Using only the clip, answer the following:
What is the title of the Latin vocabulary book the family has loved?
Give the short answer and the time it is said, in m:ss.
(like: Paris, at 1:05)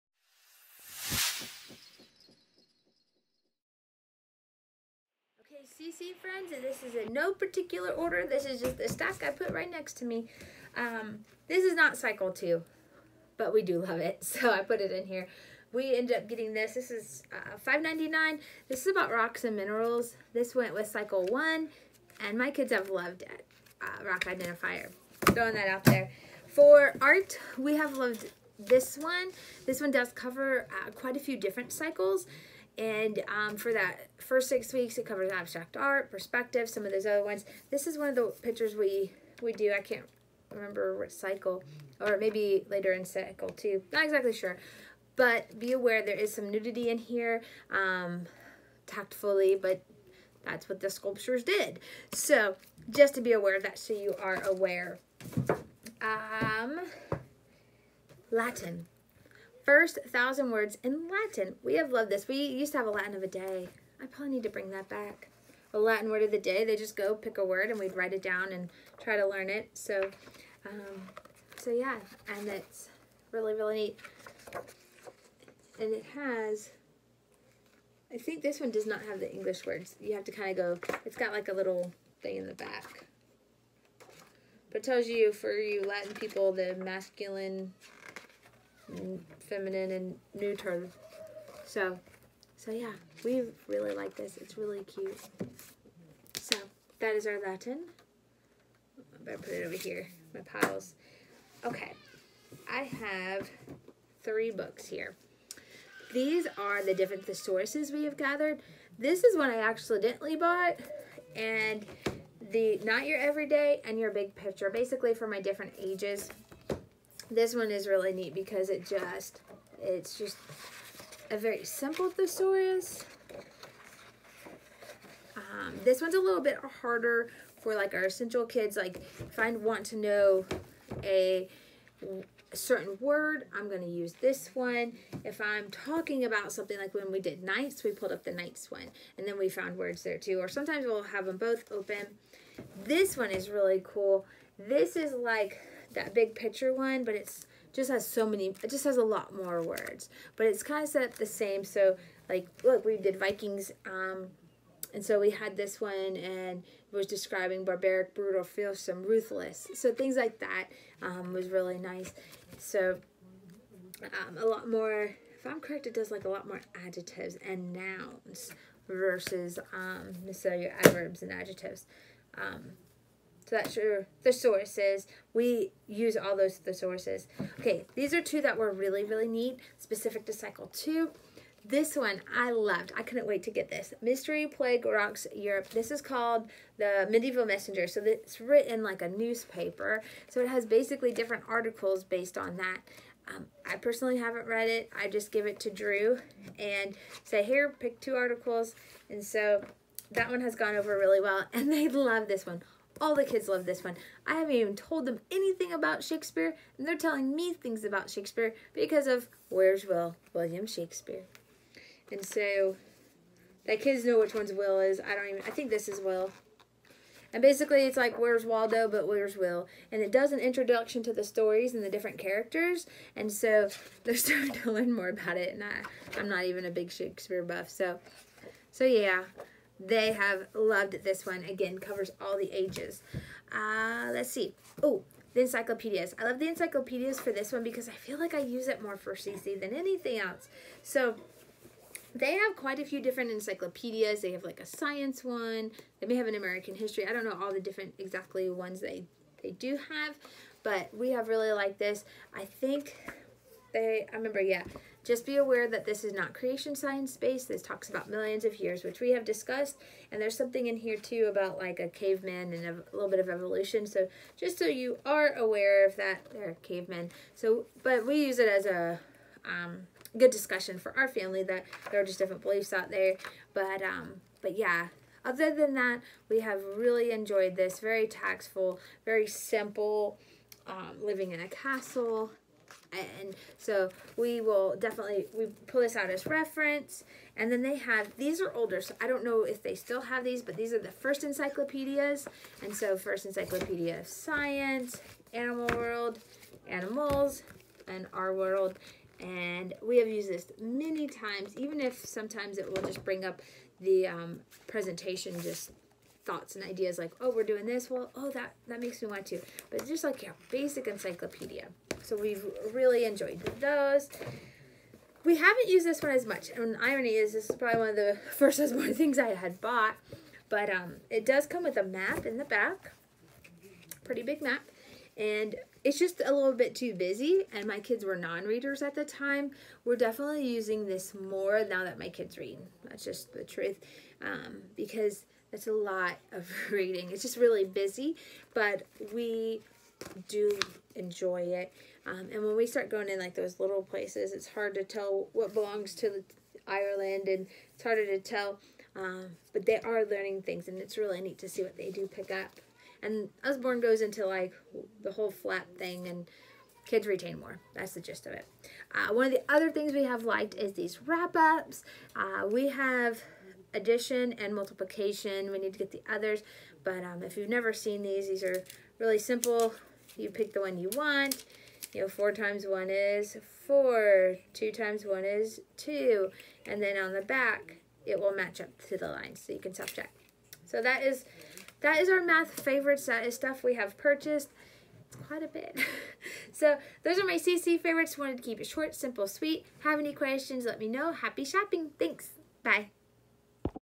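First Thousand Words in Latin, at 0:59.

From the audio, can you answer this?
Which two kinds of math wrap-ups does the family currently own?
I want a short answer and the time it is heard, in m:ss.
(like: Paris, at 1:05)
Addition and multiplication, at 6:03.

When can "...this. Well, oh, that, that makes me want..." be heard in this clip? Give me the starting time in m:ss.
5:07.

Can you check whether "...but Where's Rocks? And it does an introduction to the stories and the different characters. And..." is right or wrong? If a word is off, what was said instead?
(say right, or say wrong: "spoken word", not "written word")
wrong: "Will", not "Rocks".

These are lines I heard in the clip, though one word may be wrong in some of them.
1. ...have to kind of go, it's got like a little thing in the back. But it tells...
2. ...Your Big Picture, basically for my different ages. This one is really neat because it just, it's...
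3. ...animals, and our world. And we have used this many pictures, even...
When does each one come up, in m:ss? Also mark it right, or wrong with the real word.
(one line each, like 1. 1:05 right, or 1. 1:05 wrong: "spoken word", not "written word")
1. 1:20 right
2. 1:53 right
3. 4:56 wrong: "times", not "pictures".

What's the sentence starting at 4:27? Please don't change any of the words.
So, but we use it as a um, good discussion for our family that there are just different beliefs out there.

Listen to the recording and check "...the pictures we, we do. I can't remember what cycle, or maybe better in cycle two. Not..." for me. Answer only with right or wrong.
wrong.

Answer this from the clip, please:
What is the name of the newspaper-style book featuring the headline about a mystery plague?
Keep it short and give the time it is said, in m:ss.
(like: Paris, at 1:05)
The Medieval Messenger, at 3:06.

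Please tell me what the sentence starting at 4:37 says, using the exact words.
Very tactful, very simple, um, living in a castle, and so we will definitely, we pull this out as reference.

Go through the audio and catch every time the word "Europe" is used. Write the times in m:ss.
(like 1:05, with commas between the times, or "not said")
3:05.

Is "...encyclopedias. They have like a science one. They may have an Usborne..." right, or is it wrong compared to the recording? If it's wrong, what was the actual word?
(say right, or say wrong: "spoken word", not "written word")
wrong: "American", not "Usborne".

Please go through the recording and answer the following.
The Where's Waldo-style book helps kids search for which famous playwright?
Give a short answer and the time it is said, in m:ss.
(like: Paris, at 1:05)
William Shakespeare, at 3:30.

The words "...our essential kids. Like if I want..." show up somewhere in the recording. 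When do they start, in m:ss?
2:07.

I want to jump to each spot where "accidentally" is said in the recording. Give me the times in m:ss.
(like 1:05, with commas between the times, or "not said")
1:49.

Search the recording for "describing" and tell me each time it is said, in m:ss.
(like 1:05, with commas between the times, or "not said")
2:37.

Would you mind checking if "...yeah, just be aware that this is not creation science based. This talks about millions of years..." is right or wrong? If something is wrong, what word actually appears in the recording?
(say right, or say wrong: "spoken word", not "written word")
right.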